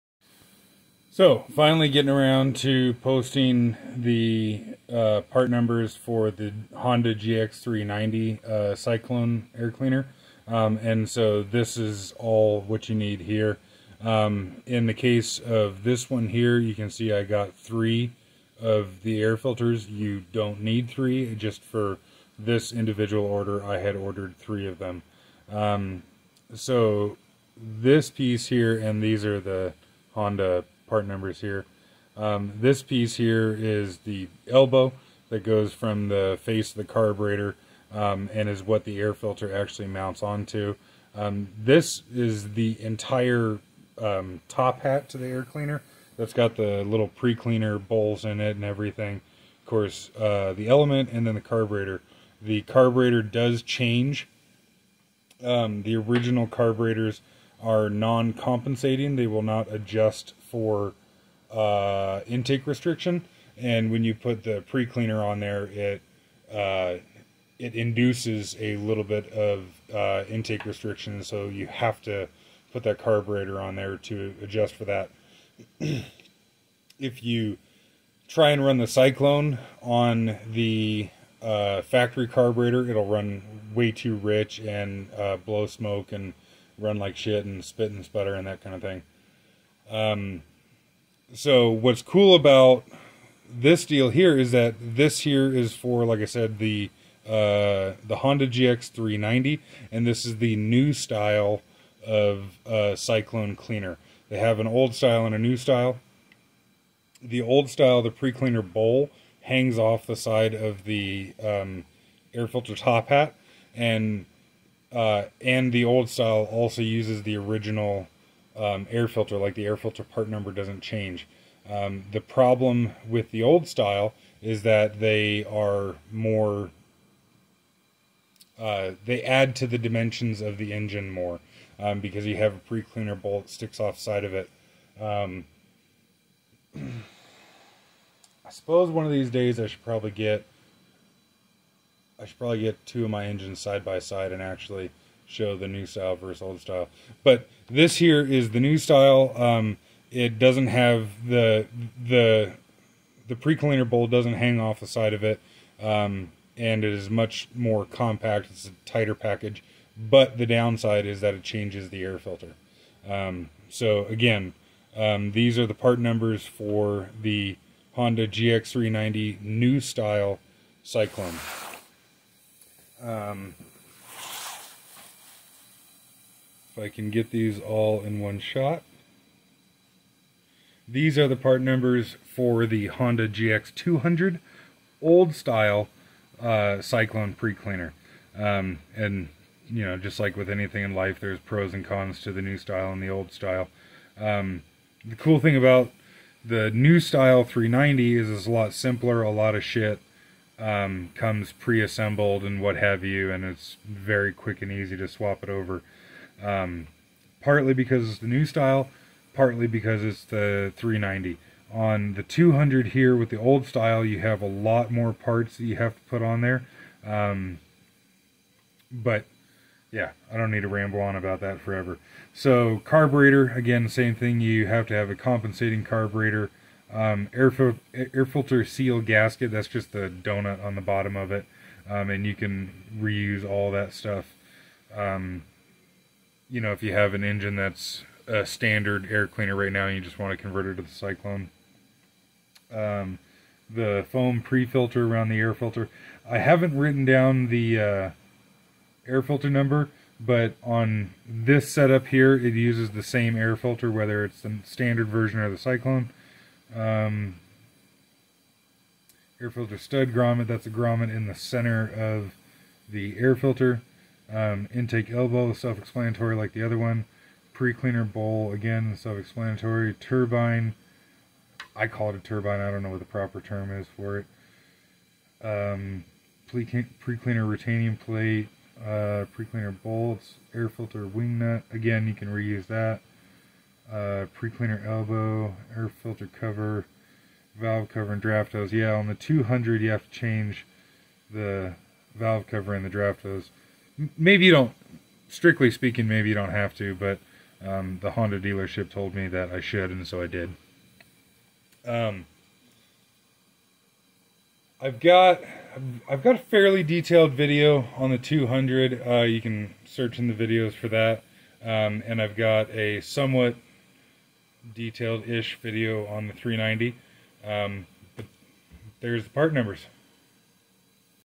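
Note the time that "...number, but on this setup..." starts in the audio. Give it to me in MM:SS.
04:09.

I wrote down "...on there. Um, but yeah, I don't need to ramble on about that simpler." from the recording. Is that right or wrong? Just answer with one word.
wrong.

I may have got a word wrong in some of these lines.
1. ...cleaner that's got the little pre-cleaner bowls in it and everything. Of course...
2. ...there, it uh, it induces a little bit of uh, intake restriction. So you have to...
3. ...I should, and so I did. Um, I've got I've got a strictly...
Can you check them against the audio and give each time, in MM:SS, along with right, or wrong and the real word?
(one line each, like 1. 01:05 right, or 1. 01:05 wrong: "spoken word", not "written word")
1. 00:45 right
2. 01:05 right
3. 04:59 wrong: "fairly", not "strictly".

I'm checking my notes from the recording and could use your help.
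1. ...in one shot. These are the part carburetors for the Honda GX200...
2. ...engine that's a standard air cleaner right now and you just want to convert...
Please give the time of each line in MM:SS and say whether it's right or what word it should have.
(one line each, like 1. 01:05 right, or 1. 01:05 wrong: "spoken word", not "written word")
1. 02:58 wrong: "numbers", not "carburetors"
2. 03:57 right.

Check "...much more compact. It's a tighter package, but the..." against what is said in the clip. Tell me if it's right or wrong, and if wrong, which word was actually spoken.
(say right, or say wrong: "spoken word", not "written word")
right.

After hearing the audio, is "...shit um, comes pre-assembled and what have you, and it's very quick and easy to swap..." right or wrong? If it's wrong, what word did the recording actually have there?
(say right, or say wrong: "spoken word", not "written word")
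right.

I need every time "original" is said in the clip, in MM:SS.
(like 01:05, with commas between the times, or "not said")
00:55, 01:57.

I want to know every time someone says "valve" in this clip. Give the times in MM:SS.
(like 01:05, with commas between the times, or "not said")
04:47, 04:52.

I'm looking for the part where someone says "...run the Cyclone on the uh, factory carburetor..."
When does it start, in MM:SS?
01:18.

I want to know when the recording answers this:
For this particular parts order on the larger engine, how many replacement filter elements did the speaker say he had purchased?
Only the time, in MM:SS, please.
00:17.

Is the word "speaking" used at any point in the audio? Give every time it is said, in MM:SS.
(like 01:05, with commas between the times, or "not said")
04:55.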